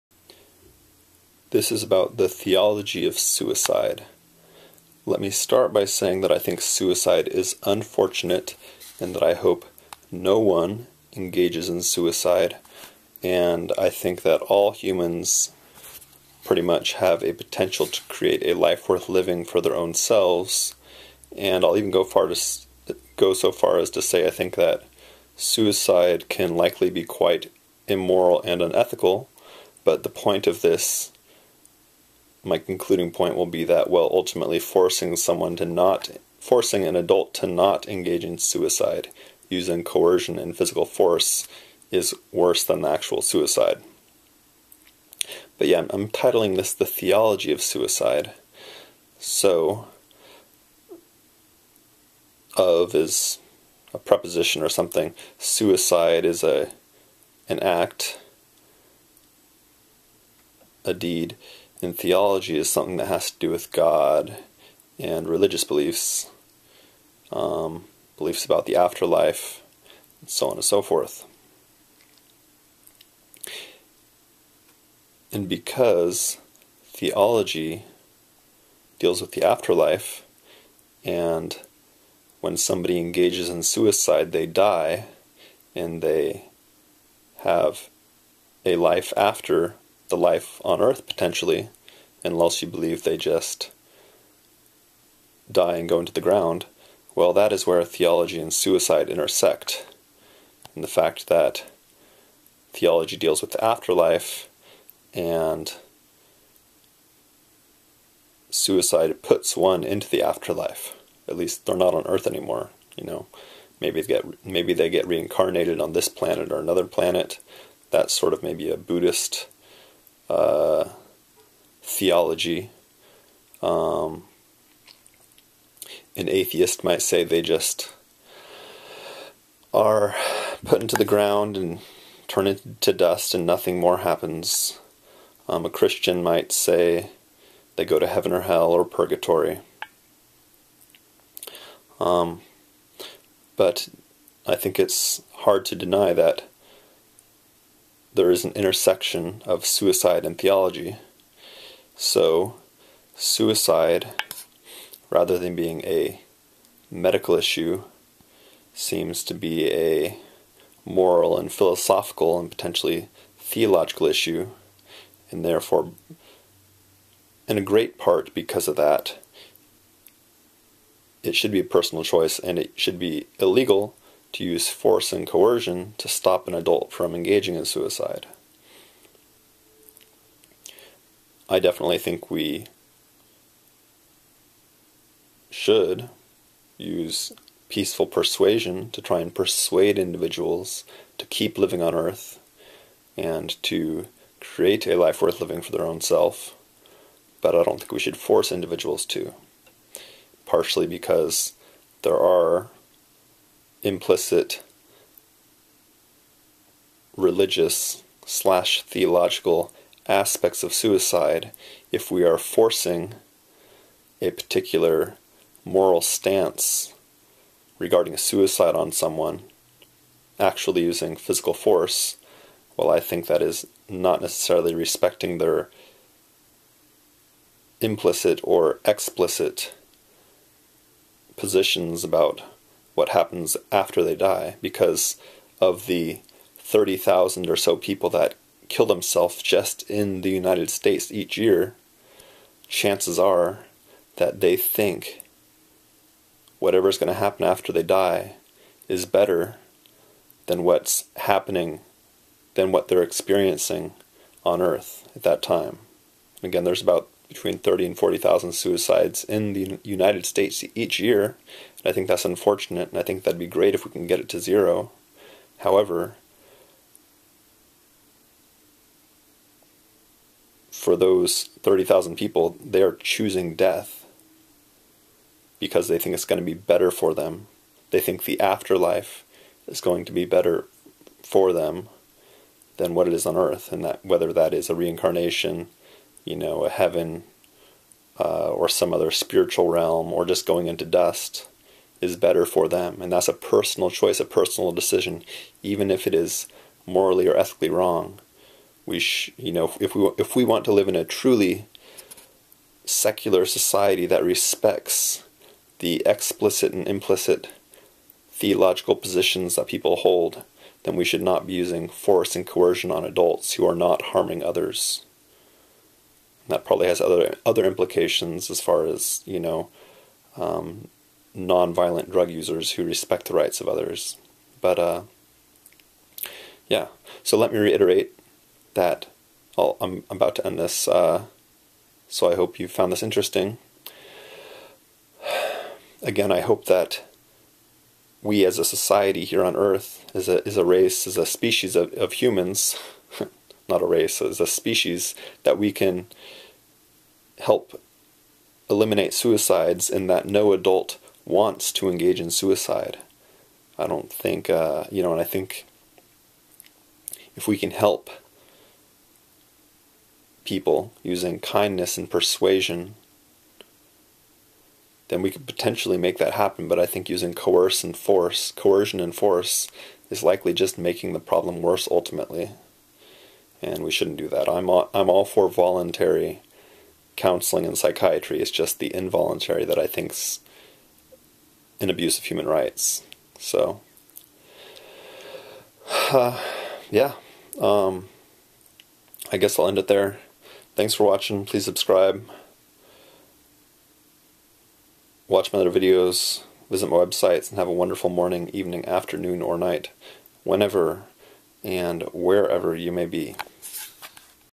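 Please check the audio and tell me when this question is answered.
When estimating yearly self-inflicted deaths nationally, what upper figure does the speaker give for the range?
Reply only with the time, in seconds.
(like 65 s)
257 s.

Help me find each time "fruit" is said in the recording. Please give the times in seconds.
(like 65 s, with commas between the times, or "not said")
not said.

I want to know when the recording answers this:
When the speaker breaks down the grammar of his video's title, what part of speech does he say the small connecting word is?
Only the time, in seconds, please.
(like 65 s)
53 s.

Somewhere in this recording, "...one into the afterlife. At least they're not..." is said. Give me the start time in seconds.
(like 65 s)
109 s.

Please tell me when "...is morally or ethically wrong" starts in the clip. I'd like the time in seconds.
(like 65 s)
296 s.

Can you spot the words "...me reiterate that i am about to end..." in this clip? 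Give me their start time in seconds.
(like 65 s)
327 s.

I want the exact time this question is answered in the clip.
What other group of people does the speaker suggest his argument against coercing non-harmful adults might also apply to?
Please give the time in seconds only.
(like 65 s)
321 s.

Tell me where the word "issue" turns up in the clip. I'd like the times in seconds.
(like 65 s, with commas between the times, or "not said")
157 s, 164 s.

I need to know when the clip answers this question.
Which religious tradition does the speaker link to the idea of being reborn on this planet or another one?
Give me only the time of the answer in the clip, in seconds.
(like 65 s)
118 s.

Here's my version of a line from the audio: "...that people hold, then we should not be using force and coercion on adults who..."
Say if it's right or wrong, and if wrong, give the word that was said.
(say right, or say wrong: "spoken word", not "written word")
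right.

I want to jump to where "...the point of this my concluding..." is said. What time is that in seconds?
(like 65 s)
30 s.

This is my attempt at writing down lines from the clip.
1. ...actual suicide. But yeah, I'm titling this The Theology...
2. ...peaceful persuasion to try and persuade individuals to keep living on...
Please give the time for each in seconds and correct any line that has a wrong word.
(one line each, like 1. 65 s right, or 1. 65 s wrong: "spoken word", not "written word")
1. 42 s right
2. 187 s right.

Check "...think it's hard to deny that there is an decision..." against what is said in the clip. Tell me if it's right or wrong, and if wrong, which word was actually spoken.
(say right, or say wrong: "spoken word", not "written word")
wrong: "intersection", not "decision".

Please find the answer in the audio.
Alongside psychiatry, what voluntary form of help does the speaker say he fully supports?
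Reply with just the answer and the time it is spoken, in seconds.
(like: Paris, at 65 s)
counseling, at 377 s.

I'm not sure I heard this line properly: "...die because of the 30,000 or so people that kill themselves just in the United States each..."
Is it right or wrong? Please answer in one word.
right.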